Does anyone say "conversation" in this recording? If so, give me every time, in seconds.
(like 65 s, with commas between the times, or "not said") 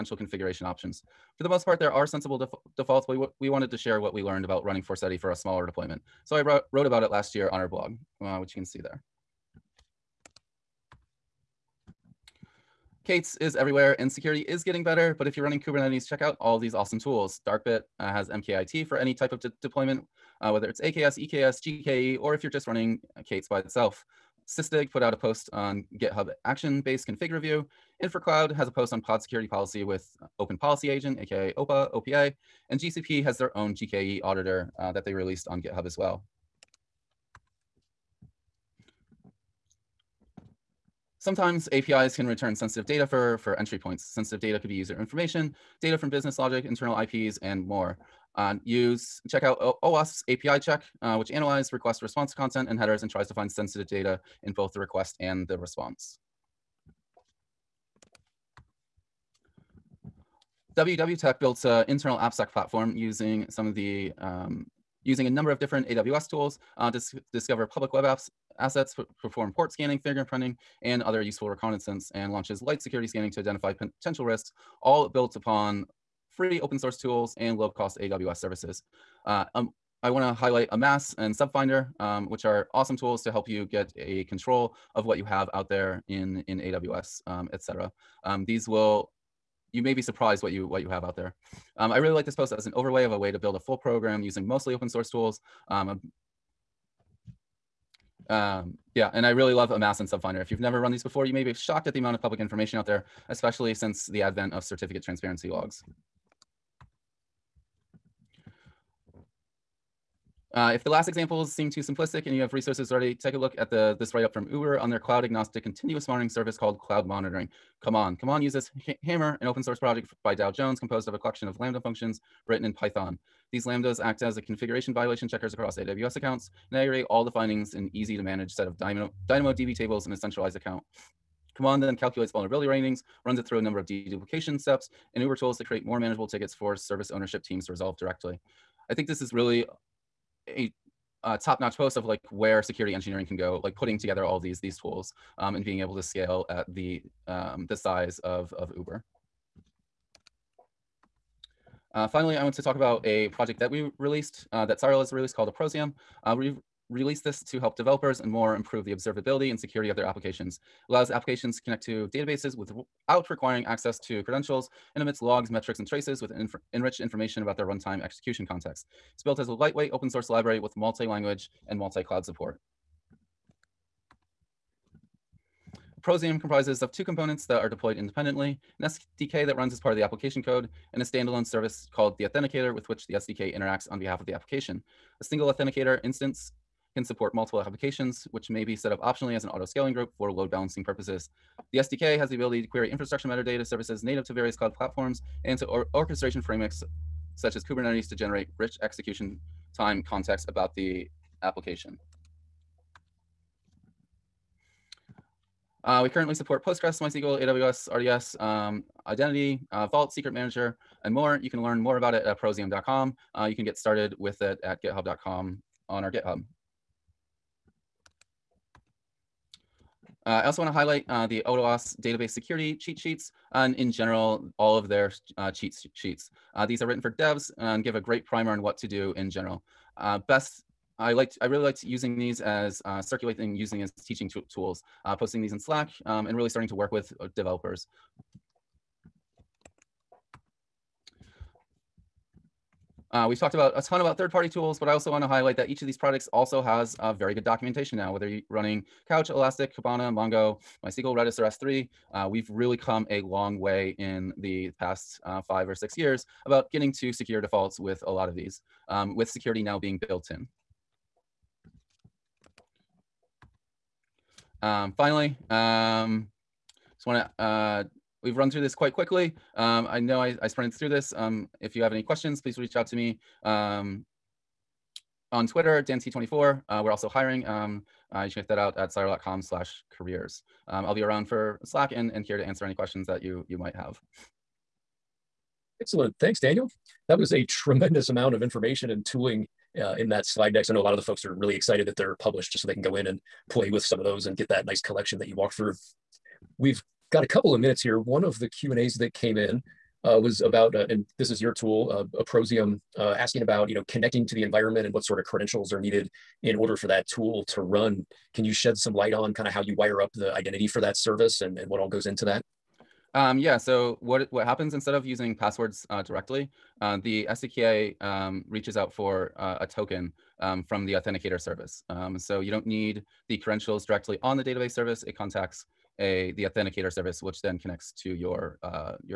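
not said.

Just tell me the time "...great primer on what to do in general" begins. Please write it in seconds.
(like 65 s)
227 s.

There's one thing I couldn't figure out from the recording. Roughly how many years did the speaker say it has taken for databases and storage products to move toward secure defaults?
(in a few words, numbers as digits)
5 or 6 years.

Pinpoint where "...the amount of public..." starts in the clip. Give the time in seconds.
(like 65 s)
101 s.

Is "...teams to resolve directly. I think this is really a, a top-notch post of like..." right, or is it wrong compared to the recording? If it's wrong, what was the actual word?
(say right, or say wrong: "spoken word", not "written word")
right.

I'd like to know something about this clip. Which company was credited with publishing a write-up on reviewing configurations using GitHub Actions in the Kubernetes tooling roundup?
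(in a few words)
Sysdig.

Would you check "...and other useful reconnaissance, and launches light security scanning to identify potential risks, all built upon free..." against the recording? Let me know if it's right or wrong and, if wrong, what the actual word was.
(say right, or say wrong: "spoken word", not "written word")
right.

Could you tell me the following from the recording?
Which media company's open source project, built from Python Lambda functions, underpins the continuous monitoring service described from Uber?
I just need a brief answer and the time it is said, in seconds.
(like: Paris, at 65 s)
Dow Jones, at 120 s.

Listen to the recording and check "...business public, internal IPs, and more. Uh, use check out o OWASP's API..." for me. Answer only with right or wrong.
wrong.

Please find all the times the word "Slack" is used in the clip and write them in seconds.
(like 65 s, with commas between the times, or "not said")
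235 s, 281 s.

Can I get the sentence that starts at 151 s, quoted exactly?
Uh, finally, I want to talk about a project that we released, uh, that Cyral has released called Approzium.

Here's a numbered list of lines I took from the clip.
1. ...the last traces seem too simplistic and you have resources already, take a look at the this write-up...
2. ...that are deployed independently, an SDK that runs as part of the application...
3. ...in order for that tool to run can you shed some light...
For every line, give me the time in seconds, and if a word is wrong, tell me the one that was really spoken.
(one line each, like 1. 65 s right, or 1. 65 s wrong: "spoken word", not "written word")
1. 110 s wrong: "examples", not "traces"
2. 177 s right
3. 306 s right.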